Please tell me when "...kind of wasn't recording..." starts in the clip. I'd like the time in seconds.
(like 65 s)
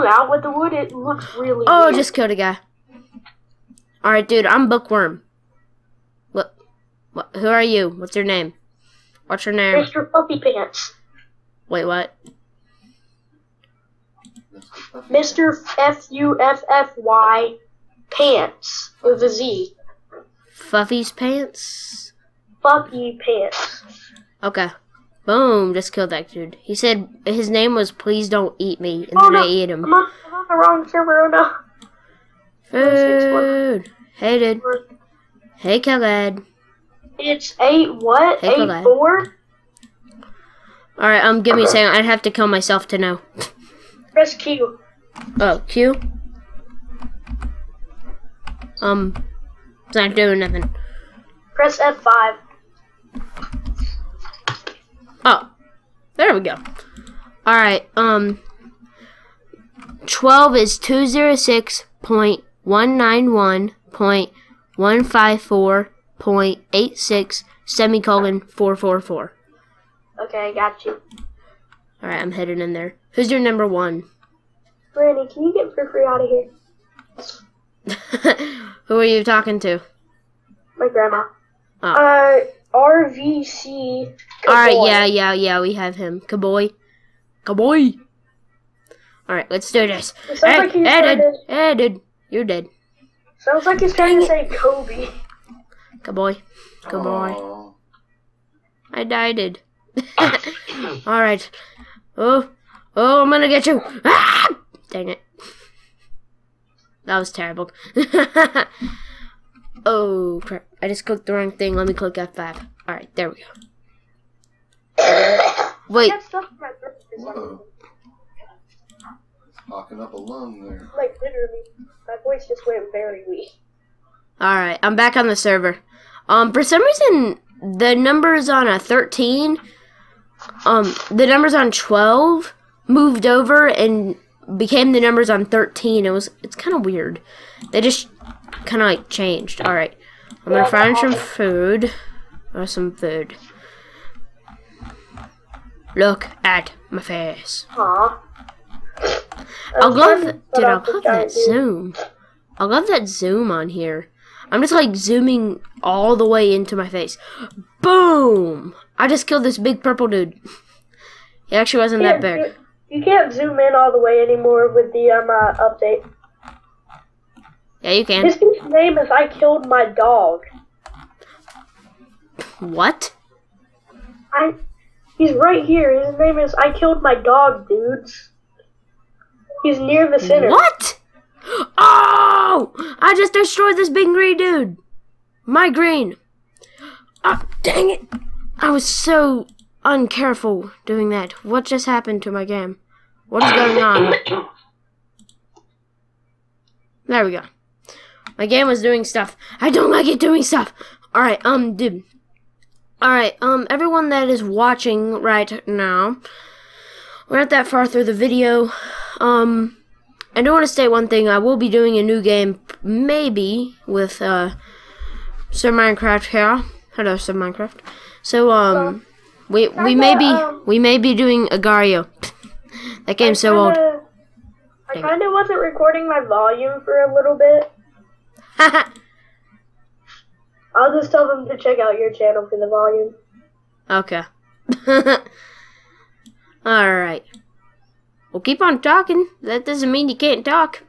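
225 s.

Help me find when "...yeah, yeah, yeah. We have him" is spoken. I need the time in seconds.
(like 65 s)
84 s.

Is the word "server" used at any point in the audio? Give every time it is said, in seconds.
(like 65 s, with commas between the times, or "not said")
30 s, 125 s.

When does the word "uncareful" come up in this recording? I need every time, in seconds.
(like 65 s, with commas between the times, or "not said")
189 s.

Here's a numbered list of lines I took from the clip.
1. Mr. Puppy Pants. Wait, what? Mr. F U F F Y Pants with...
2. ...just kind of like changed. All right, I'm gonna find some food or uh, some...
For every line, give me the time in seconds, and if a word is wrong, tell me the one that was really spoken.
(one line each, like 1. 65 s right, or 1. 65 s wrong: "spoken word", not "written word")
1. 9 s right
2. 137 s right.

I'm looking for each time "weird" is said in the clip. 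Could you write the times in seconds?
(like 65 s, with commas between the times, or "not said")
1 s, 136 s.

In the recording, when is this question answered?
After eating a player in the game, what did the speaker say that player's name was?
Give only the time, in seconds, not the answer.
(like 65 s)
27 s.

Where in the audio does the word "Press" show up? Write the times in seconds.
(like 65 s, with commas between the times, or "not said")
44 s, 51 s.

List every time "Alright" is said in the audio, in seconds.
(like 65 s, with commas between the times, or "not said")
4 s, 40 s, 57 s, 101 s, 112 s, 236 s.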